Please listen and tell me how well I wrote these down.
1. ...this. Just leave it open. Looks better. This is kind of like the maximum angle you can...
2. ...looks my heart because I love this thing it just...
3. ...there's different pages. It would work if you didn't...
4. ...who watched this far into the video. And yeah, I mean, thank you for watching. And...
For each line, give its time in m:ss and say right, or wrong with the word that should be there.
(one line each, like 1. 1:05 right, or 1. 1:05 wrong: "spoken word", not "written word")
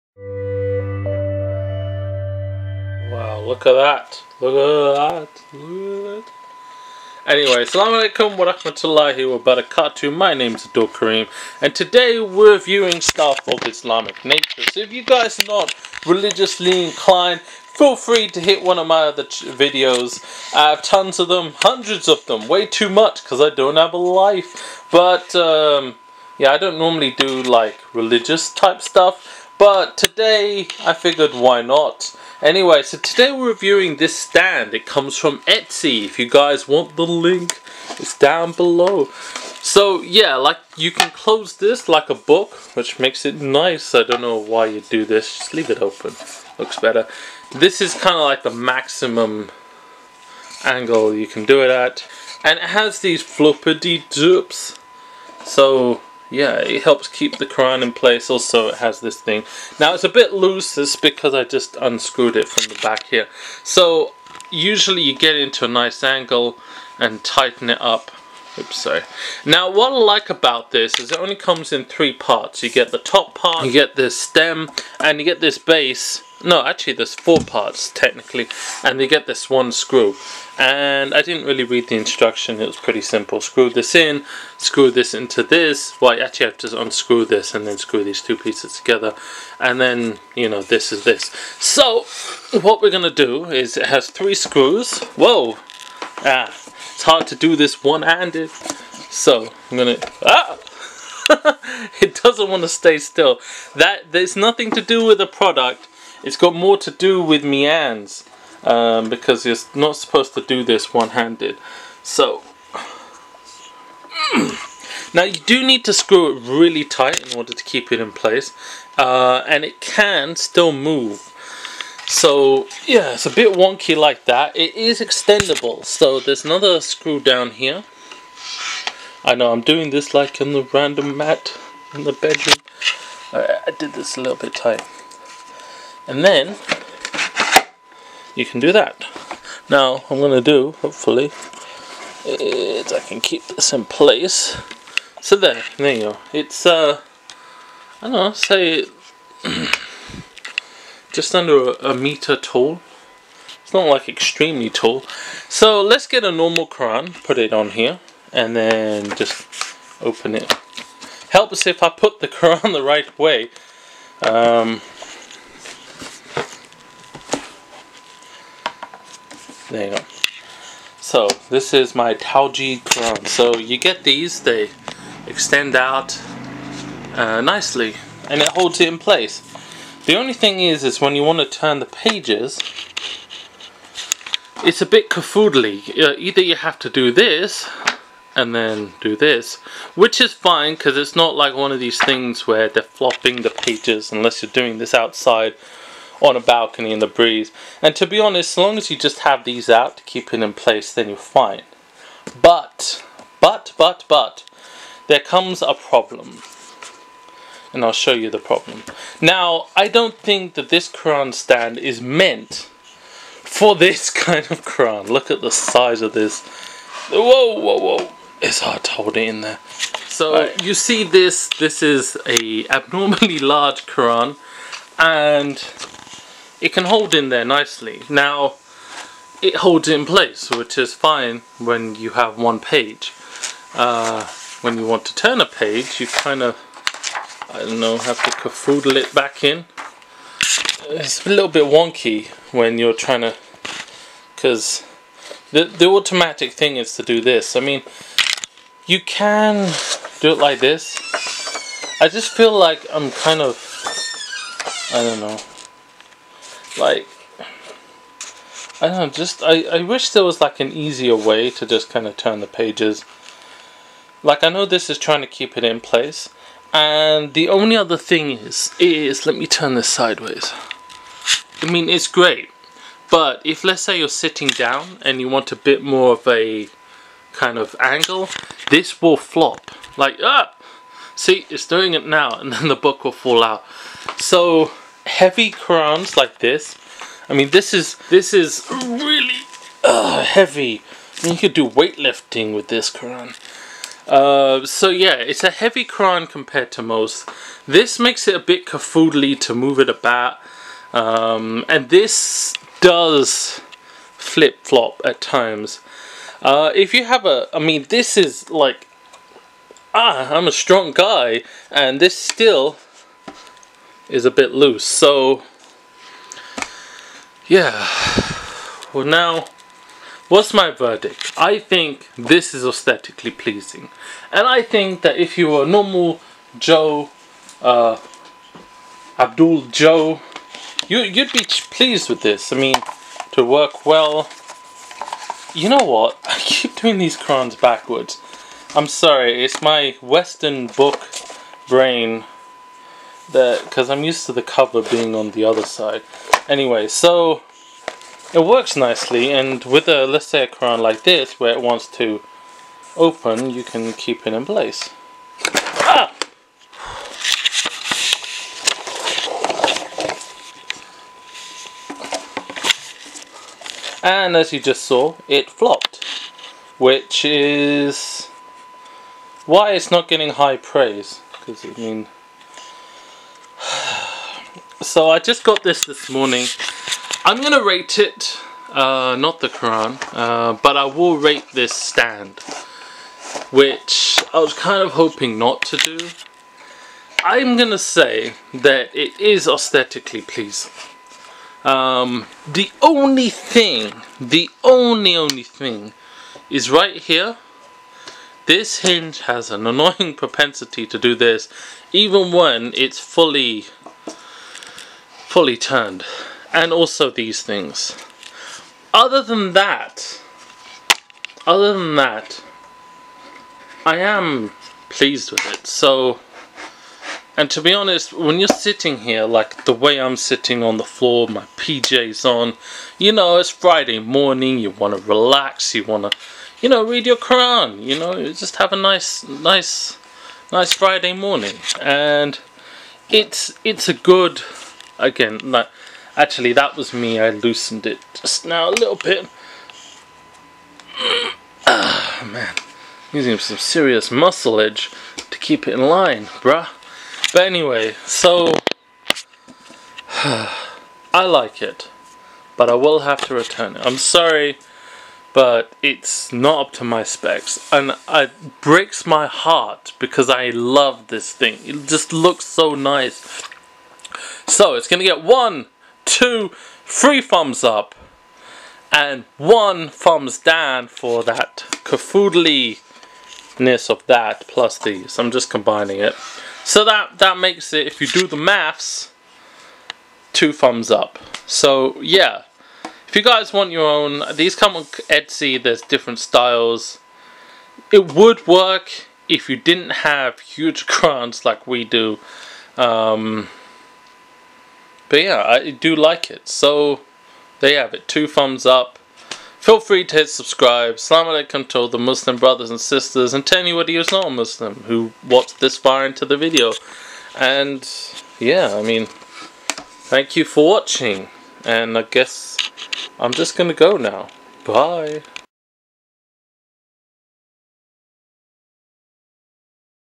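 1. 0:45 right
2. 7:38 wrong: "breaks", not "looks"
3. 8:05 wrong: "styles", not "pages"
4. 8:24 right.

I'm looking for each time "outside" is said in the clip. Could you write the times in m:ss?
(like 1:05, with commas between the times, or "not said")
3:14.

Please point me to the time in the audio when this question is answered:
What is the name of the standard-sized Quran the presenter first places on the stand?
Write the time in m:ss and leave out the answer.
2:52.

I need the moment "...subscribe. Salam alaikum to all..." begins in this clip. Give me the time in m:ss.
8:20.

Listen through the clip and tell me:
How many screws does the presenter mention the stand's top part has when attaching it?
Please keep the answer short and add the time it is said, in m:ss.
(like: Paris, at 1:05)
3, at 1:34.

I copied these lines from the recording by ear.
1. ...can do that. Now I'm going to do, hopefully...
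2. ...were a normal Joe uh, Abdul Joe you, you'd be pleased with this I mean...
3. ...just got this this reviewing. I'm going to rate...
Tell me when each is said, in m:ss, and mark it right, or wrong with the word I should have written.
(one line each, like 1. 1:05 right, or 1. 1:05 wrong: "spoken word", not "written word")
1. 2:18 right
2. 5:25 right
3. 6:15 wrong: "morning", not "reviewing".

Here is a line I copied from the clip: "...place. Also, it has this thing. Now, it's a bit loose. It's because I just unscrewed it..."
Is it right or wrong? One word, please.
right.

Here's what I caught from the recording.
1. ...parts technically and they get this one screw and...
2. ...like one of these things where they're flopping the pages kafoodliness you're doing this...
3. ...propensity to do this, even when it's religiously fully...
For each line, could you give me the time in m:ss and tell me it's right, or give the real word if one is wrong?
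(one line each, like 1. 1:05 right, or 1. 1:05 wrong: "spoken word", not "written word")
1. 1:17 right
2. 3:11 wrong: "unless", not "kafoodliness"
3. 6:40 wrong: "fully", not "religiously".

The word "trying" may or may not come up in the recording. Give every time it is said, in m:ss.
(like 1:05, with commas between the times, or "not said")
4:02, 4:24.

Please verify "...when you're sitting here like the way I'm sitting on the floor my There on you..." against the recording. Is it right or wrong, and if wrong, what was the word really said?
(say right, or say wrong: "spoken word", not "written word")
wrong: "PJs", not "There".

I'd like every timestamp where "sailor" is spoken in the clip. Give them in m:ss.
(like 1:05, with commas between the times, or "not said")
not said.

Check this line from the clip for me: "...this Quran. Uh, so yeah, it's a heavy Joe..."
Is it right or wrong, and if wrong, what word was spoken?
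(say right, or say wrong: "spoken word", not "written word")
wrong: "Quran", not "Joe".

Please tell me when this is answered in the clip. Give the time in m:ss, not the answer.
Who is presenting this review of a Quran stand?
0:10.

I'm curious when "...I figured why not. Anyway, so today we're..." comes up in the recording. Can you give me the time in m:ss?
0:30.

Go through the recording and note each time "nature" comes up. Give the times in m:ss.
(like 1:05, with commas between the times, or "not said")
0:14.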